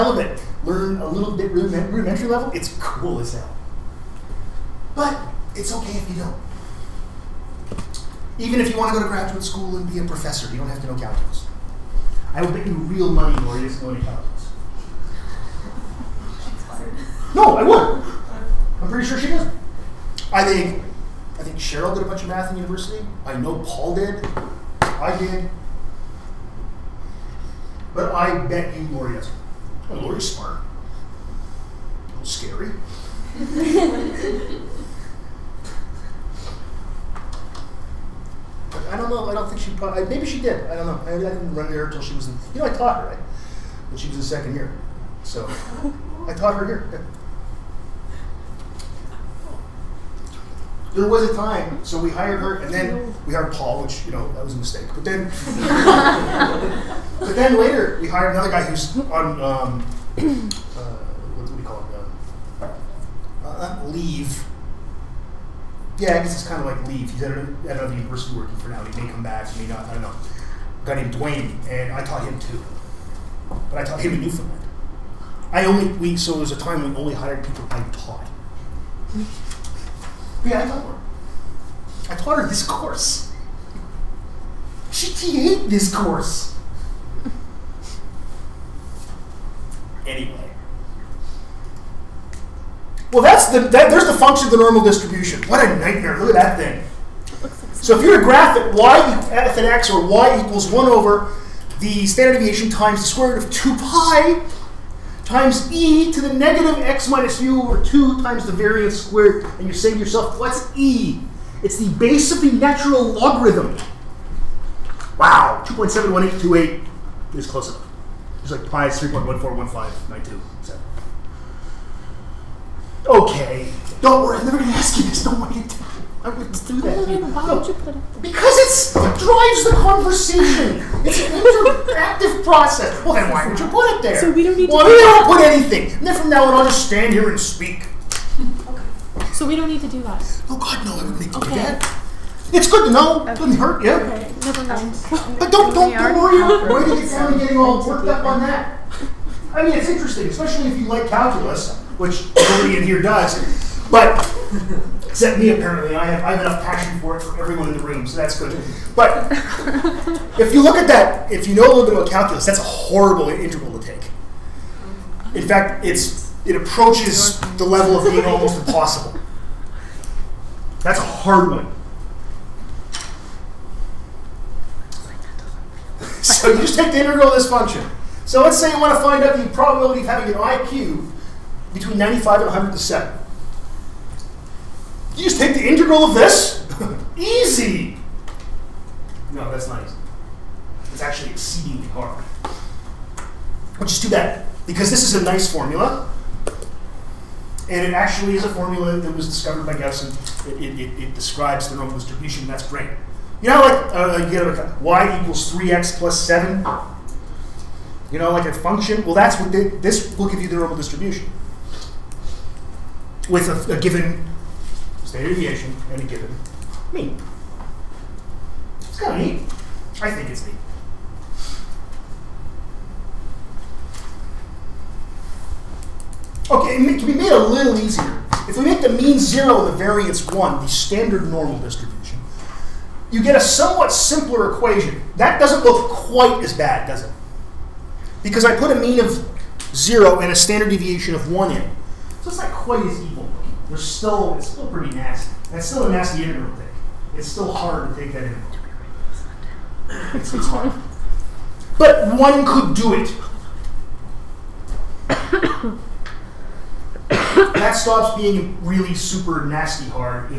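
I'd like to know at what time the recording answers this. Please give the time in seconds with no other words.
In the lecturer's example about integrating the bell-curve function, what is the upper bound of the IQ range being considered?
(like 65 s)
182 s.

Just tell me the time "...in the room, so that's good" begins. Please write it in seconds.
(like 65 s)
157 s.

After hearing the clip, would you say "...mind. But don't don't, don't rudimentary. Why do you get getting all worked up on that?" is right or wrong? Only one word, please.
wrong.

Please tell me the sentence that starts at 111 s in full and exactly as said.
It's the base of the natural logarithm.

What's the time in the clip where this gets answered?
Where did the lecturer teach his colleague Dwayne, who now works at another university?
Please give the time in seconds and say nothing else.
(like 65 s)
74 s.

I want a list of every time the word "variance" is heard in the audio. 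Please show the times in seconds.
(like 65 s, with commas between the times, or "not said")
108 s, 229 s.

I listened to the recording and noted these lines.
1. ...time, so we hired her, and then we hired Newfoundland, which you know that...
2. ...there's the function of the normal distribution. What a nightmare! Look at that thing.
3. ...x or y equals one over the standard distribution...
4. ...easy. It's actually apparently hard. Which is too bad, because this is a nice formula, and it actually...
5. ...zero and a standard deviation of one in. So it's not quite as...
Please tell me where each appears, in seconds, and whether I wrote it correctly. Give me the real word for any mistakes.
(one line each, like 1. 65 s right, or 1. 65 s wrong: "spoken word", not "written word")
1. 51 s wrong: "Paul", not "Newfoundland"
2. 93 s right
3. 99 s wrong: "deviation", not "distribution"
4. 189 s wrong: "exceedingly", not "apparently"
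5. 239 s right.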